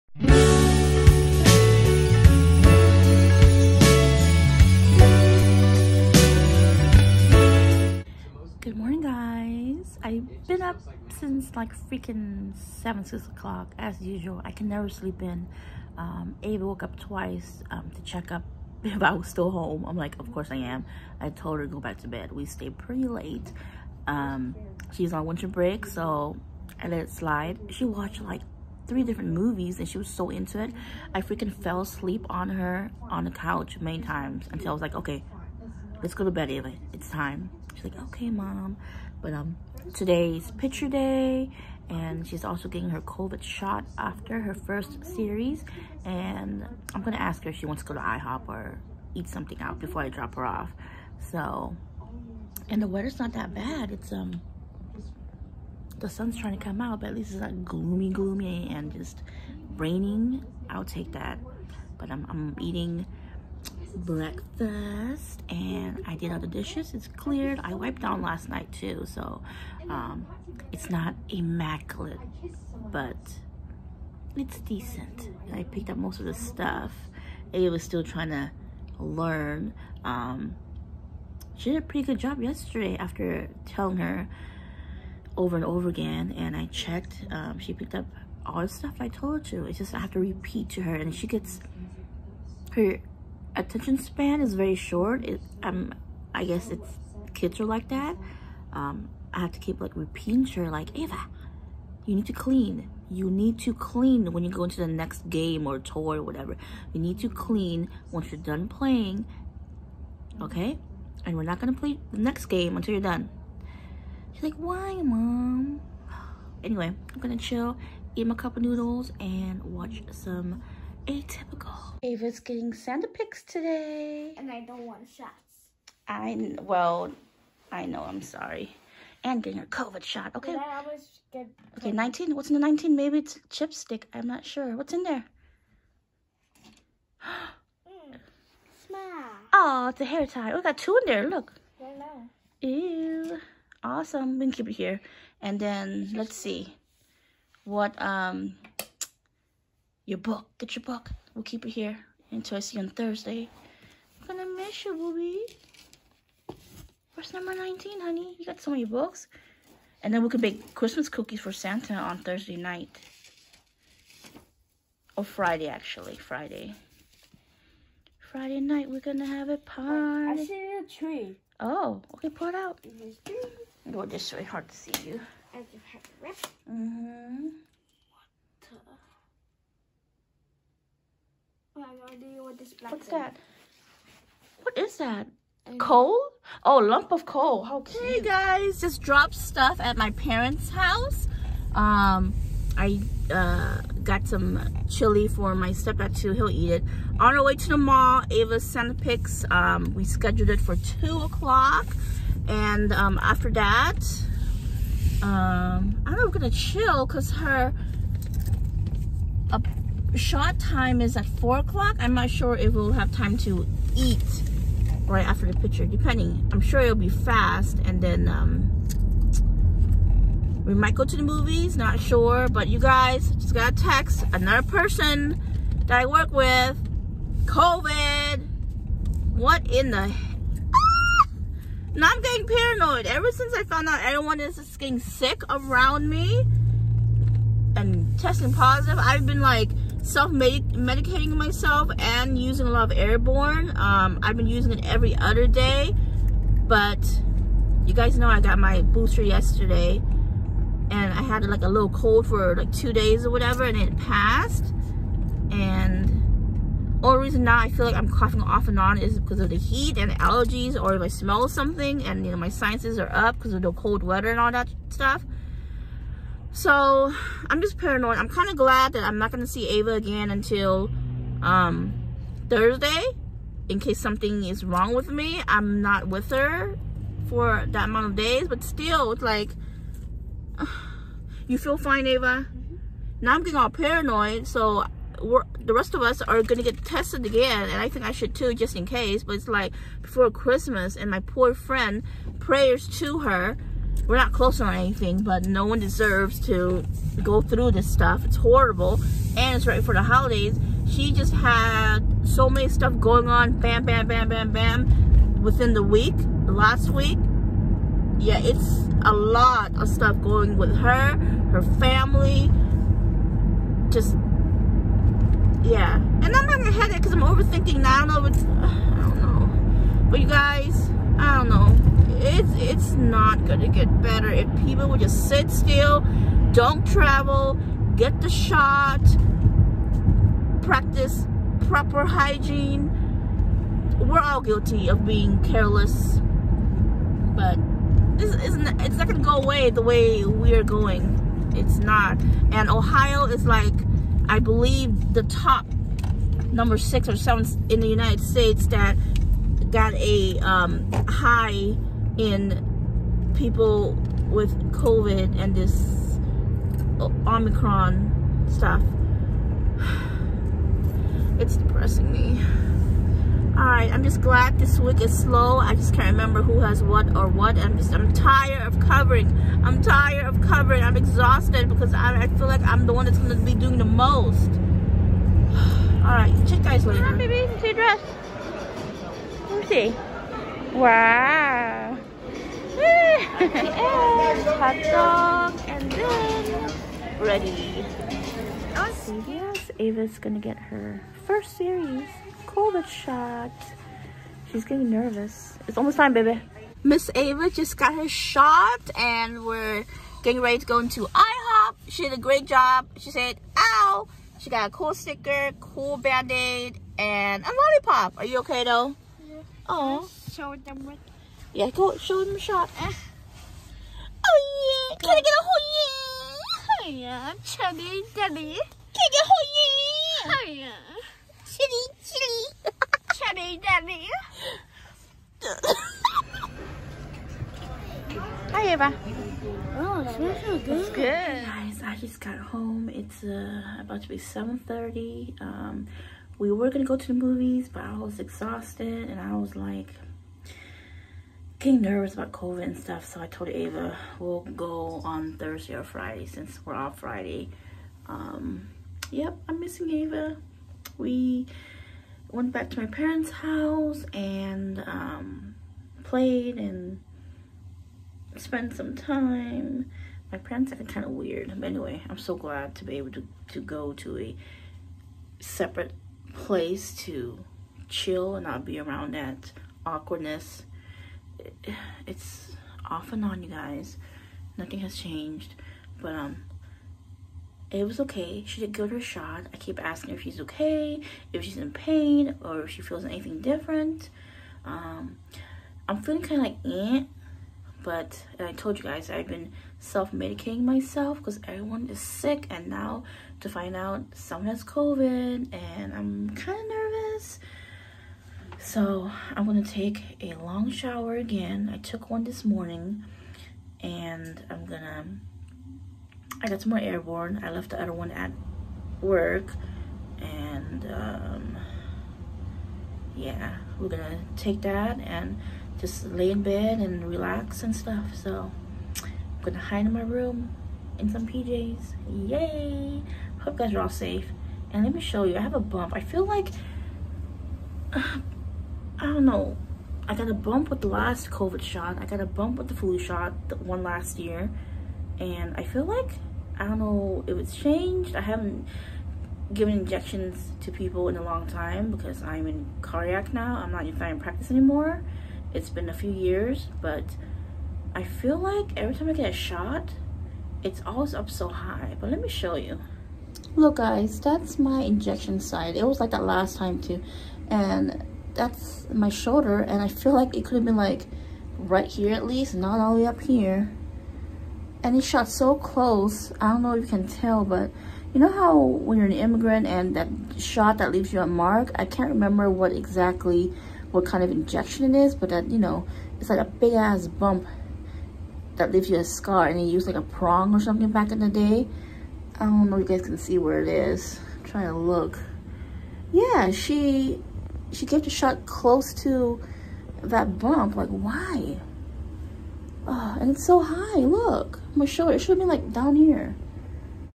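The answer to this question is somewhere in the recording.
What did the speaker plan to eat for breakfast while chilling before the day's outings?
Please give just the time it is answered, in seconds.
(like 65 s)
118 s.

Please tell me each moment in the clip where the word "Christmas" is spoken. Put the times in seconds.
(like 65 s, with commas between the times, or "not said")
160 s, 290 s.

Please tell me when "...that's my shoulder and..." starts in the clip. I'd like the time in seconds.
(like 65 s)
558 s.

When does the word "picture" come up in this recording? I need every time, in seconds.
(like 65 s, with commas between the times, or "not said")
40 s, 215 s.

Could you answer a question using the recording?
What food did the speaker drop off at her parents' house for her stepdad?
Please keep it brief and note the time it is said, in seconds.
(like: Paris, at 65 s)
Chili, at 194 s.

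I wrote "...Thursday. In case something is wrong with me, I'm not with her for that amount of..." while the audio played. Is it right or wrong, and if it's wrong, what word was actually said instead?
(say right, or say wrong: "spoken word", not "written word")
right.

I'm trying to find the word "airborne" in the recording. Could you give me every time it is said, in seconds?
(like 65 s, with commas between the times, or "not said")
242 s, 506 s.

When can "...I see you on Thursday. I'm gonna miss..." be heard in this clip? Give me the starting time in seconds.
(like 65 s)
152 s.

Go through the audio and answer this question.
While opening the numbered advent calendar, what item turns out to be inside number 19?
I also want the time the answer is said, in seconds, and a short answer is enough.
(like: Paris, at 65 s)
Hair tie, at 140 s.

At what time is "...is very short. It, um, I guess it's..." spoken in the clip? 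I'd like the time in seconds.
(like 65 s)
94 s.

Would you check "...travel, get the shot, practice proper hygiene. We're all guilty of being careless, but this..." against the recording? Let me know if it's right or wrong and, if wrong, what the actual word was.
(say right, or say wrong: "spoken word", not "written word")
right.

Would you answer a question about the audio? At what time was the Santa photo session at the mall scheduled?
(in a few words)
2 o'clock.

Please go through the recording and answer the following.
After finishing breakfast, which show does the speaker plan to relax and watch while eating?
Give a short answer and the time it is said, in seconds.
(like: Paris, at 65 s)
Atypical, at 121 s.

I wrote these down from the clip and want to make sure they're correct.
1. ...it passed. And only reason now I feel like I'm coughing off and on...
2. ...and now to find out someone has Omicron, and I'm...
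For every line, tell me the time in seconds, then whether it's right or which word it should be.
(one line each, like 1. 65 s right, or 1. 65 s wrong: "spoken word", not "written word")
1. 253 s right
2. 492 s wrong: "COVID", not "Omicron".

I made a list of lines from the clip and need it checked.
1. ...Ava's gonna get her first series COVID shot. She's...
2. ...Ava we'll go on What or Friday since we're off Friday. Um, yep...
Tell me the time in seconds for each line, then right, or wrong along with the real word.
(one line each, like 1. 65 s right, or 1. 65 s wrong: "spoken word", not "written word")
1. 389 s right
2. 443 s wrong: "Thursday", not "What".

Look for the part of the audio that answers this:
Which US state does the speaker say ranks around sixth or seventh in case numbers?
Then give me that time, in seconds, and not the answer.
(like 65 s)
342 s.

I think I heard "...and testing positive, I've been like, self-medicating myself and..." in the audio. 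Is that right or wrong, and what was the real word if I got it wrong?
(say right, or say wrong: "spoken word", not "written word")
right.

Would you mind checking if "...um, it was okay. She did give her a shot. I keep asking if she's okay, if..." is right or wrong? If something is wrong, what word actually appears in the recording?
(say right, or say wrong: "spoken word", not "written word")
right.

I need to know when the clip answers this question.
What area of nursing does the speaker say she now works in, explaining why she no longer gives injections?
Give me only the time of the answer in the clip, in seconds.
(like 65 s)
542 s.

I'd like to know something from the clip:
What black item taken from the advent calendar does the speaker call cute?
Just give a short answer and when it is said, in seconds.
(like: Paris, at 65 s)
Lump of coal, at 186 s.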